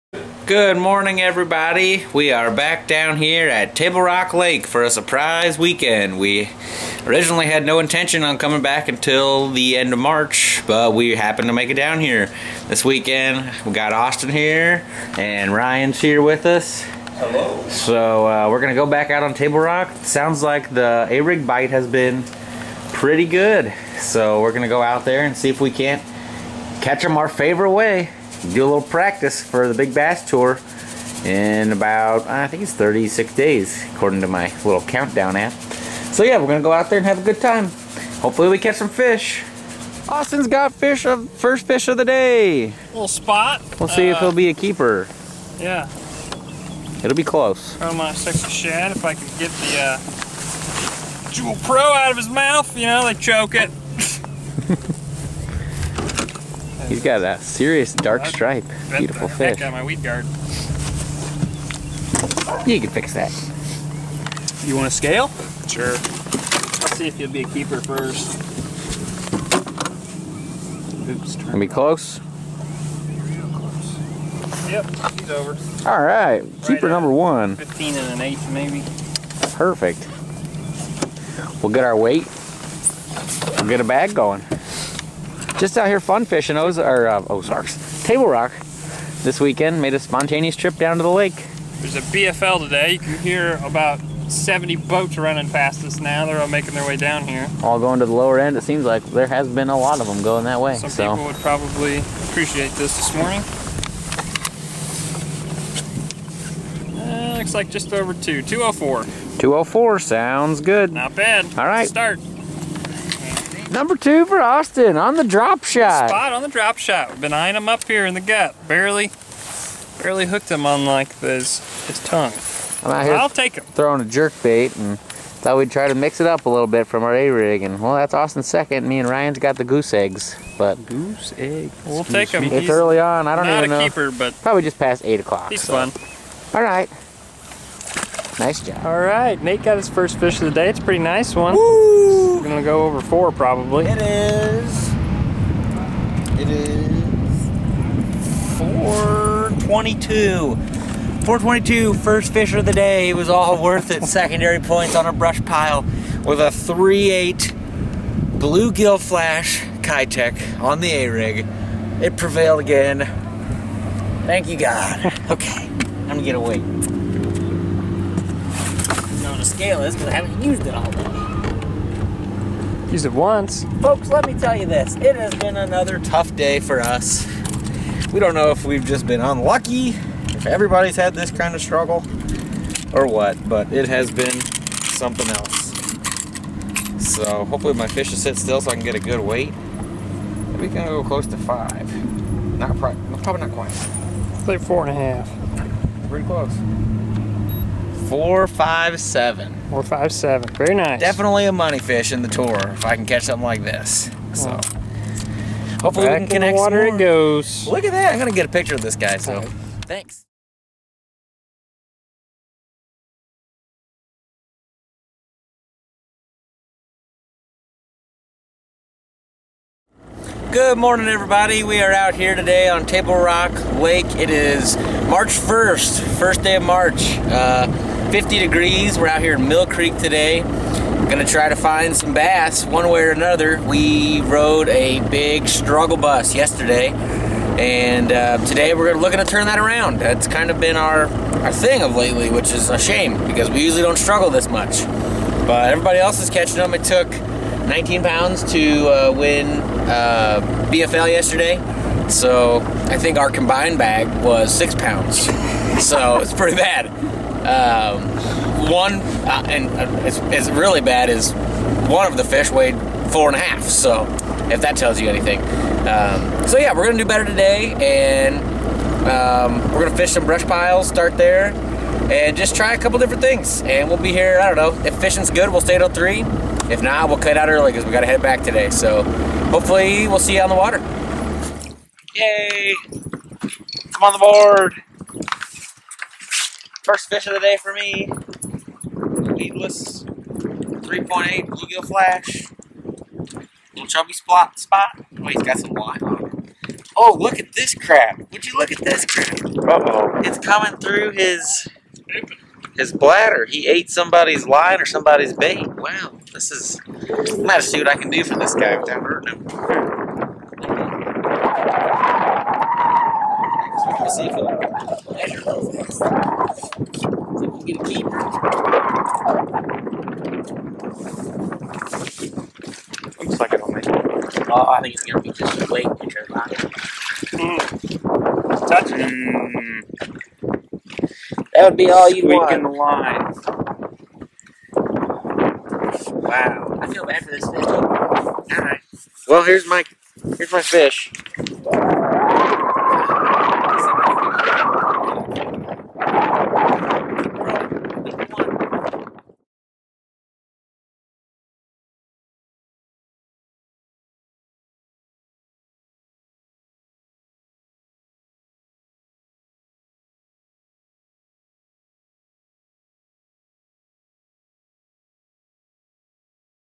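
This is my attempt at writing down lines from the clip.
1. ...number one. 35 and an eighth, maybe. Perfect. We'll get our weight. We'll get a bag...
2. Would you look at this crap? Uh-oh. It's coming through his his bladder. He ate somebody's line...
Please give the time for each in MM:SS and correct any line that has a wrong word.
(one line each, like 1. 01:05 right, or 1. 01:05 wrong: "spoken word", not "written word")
1. 01:16 wrong: "15", not "35"
2. 04:58 right.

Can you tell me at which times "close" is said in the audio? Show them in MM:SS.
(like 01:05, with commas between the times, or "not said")
00:47, 01:11, 03:11, 03:16.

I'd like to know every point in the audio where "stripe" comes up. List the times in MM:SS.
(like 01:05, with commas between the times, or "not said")
00:58.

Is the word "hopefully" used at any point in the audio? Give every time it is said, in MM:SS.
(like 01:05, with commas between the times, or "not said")
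00:38, 03:07, 03:25, 04:39.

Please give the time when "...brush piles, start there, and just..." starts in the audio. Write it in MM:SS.
04:30.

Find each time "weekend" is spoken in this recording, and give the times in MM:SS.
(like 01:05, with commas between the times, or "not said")
00:05, 00:12, 01:29.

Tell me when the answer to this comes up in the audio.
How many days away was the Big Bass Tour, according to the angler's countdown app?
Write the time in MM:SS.
00:32.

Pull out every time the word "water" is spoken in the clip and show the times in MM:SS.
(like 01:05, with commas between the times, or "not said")
03:26, 04:40.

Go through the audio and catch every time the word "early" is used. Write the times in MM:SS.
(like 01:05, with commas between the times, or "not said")
02:12, 04:37.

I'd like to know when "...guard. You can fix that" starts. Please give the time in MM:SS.
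01:00.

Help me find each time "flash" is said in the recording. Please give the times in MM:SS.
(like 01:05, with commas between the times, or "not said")
02:38, 04:51.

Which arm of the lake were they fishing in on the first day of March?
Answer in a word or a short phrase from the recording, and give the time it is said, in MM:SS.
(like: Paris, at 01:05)
Mill Creek, at 03:49.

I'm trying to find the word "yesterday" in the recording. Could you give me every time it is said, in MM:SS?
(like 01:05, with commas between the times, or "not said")
03:56, 04:11.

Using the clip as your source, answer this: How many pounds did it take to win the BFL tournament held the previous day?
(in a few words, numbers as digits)
19.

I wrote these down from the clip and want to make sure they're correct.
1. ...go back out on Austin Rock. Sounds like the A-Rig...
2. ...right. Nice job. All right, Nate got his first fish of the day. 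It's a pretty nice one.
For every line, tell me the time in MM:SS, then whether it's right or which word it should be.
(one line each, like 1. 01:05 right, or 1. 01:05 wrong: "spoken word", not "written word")
1. 00:18 wrong: "Table", not "Austin"
2. 02:16 right.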